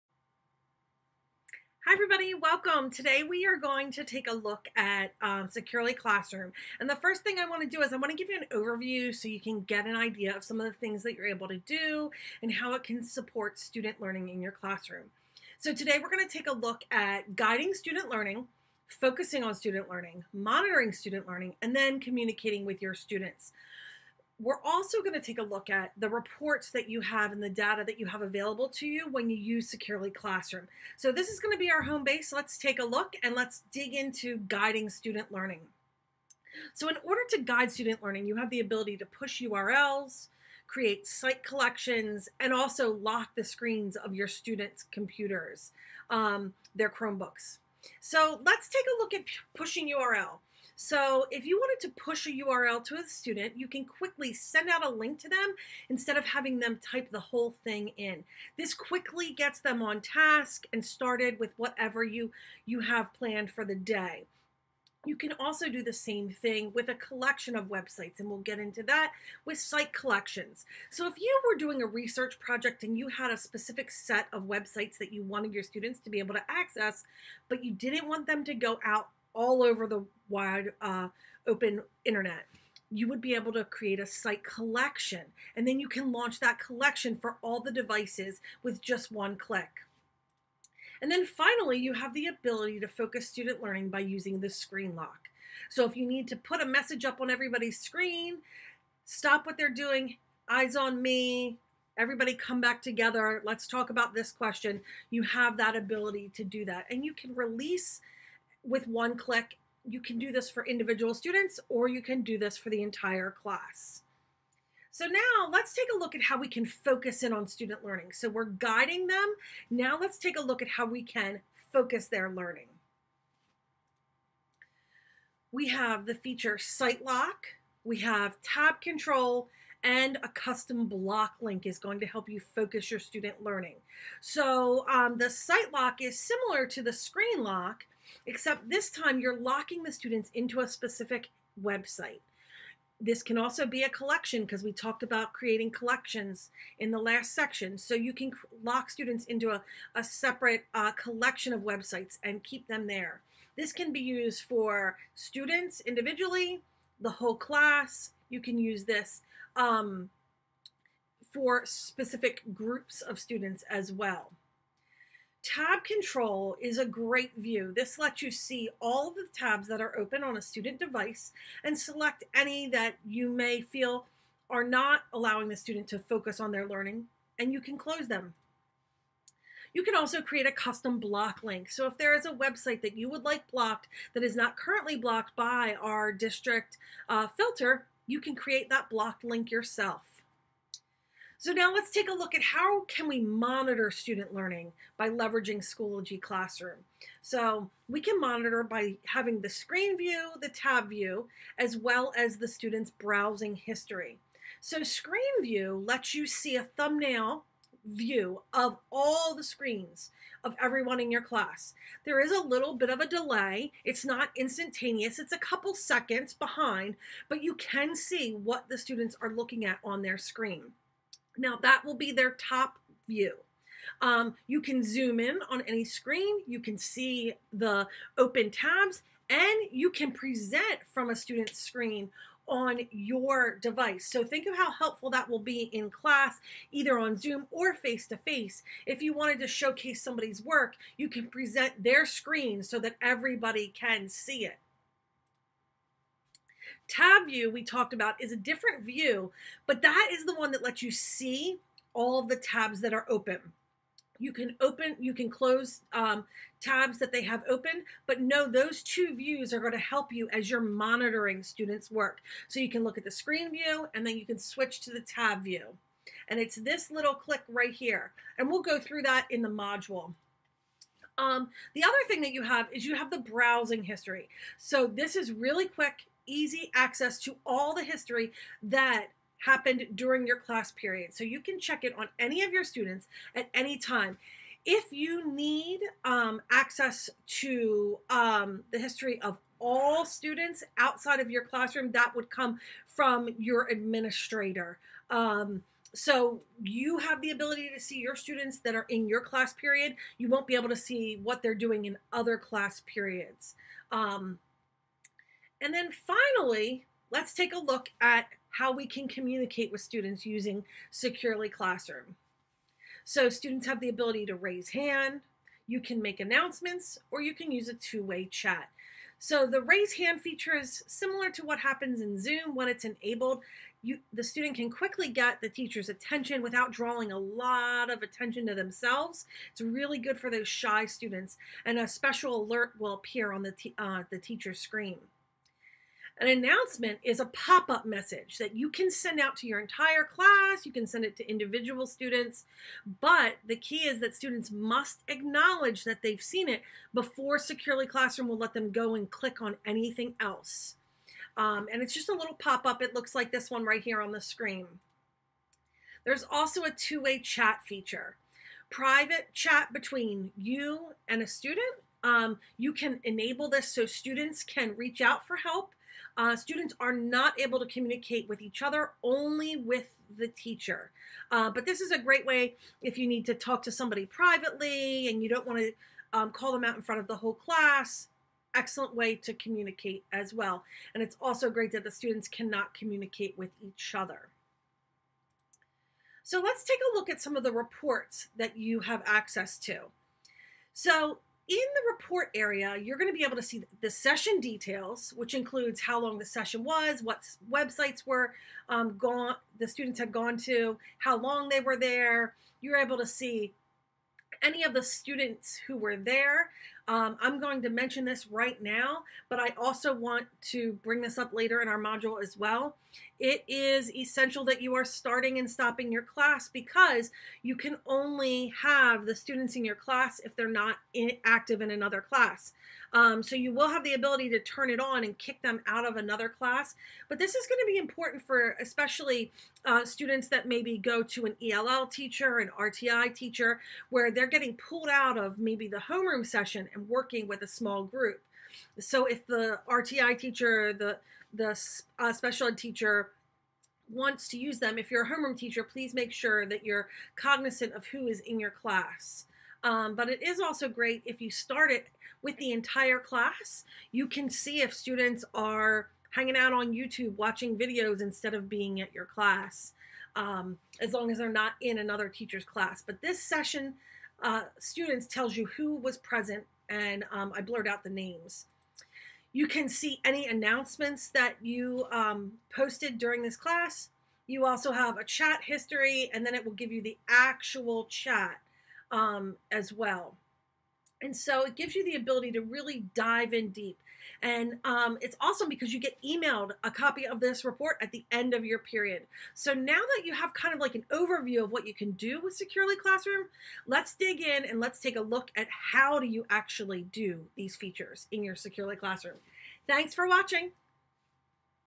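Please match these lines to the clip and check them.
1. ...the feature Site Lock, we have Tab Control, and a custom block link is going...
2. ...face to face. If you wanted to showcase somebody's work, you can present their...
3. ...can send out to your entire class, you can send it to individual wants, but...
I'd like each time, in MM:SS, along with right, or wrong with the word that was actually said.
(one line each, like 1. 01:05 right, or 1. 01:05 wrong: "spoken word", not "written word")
1. 02:06 right
2. 03:57 right
3. 05:38 wrong: "students", not "wants".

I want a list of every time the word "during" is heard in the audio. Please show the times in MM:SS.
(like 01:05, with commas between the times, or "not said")
04:39, 07:52.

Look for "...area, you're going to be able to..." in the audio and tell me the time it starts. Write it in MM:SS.
06:32.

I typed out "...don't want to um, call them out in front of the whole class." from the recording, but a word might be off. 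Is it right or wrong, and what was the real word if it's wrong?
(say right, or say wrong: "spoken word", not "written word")
right.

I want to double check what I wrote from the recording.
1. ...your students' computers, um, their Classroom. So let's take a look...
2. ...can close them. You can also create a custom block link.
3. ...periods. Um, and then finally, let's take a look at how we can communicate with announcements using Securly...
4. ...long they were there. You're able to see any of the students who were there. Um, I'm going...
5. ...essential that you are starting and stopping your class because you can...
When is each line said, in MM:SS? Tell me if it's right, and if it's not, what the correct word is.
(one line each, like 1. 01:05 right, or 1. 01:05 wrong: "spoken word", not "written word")
1. 00:44 wrong: "Chromebooks", not "Classroom"
2. 02:57 right
3. 05:02 wrong: "students", not "announcements"
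4. 06:41 right
5. 06:53 right.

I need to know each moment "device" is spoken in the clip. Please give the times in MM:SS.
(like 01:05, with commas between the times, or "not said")
01:27, 02:50, 03:53.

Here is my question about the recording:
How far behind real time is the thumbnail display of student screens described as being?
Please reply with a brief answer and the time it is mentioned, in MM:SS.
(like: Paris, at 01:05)
A couple seconds, at 03:35.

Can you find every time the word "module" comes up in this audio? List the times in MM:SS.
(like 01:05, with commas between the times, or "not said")
04:29, 06:51.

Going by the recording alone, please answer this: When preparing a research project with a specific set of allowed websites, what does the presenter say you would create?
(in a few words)
Site collection.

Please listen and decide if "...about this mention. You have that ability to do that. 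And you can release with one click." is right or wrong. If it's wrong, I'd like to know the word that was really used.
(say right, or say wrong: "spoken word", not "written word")
wrong: "question", not "mention".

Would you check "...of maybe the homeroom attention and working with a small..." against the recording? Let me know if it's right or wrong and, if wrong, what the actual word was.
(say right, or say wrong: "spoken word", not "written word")
wrong: "session", not "attention".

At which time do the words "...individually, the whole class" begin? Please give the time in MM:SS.
02:35.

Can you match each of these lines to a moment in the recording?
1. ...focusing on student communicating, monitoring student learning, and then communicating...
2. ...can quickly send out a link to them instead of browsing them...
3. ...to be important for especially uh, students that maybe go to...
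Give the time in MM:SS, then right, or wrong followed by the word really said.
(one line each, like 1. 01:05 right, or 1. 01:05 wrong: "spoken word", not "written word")
1. 00:18 wrong: "learning", not "communicating"
2. 00:53 wrong: "having", not "browsing"
3. 07:07 right.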